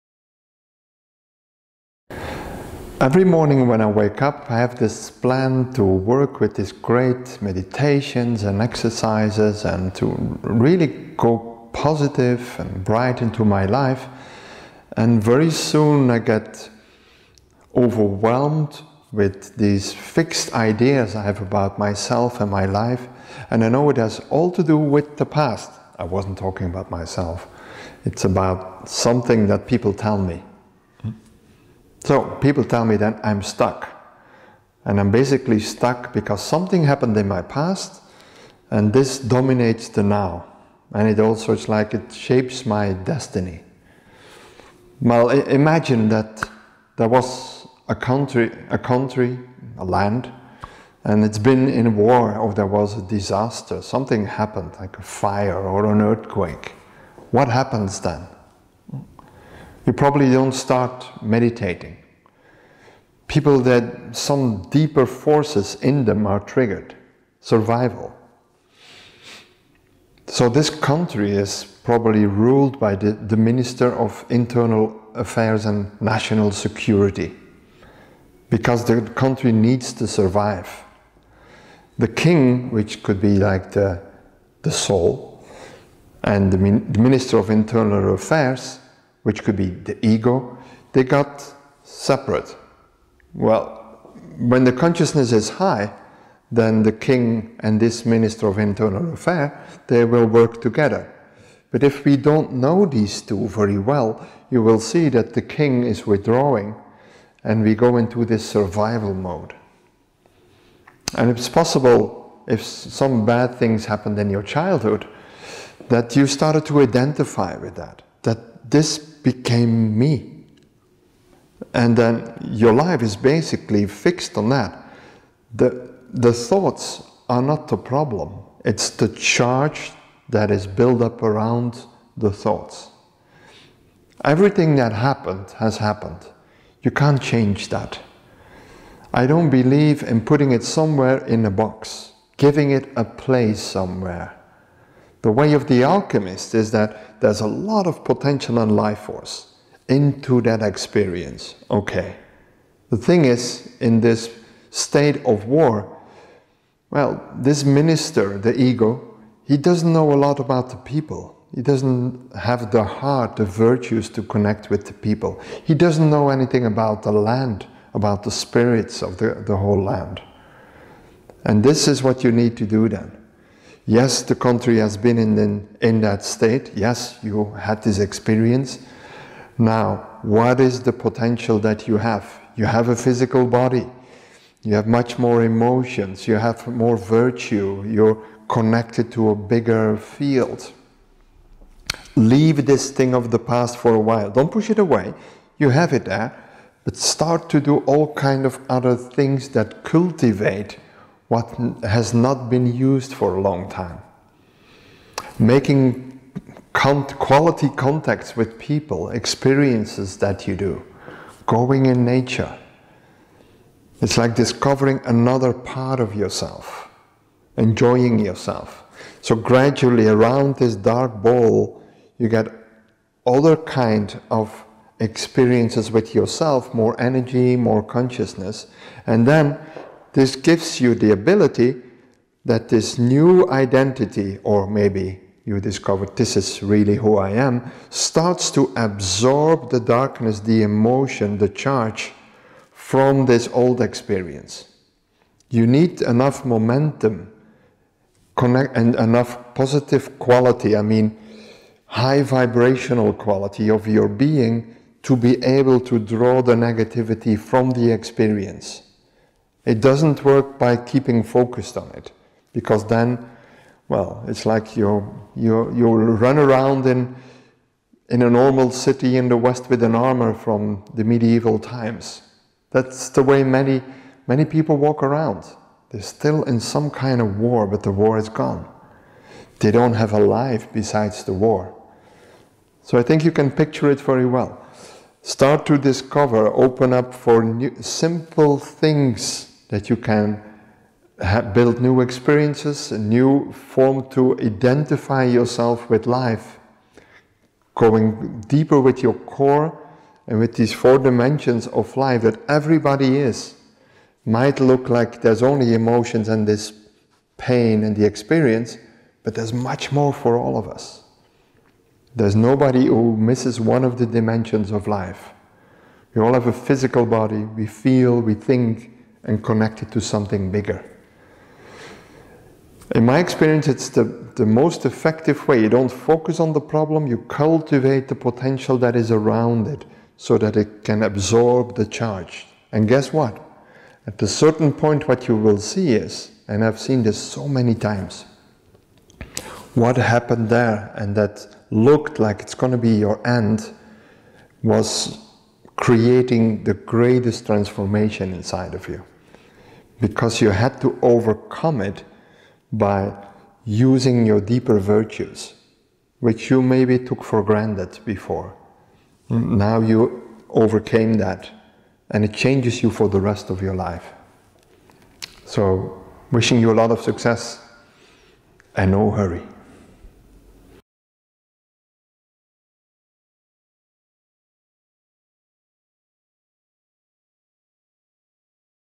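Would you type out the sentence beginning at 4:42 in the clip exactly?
So I think you can picture it very well.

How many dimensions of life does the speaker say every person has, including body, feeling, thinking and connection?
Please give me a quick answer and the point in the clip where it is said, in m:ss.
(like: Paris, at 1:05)
4, at 5:00.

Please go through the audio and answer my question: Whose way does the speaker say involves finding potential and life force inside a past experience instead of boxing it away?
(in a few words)
The alchemist.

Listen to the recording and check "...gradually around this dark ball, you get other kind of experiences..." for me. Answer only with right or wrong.
right.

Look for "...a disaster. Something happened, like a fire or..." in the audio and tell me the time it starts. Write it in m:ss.
0:52.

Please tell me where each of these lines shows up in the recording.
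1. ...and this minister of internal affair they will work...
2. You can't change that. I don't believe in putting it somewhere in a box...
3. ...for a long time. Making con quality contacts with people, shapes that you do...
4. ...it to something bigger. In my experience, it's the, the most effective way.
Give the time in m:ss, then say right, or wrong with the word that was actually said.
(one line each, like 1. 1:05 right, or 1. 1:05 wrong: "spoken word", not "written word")
1. 1:37 right
2. 2:16 right
3. 3:23 wrong: "experiences", not "shapes"
4. 5:19 right.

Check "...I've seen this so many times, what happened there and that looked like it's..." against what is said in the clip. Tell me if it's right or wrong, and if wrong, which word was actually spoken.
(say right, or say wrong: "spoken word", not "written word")
right.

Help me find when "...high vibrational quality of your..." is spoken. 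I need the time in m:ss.
4:11.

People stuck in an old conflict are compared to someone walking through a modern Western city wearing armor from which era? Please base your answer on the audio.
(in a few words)
Medieval times.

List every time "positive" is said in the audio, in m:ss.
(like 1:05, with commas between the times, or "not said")
0:11, 4:09.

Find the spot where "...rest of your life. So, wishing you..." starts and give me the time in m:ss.
6:03.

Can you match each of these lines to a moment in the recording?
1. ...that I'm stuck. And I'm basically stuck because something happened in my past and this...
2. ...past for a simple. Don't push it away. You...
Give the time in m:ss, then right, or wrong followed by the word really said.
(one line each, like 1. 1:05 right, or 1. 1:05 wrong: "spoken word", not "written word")
1. 0:32 right
2. 3:13 wrong: "while", not "simple".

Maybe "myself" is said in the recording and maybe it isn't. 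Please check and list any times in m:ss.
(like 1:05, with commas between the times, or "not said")
0:21, 0:26.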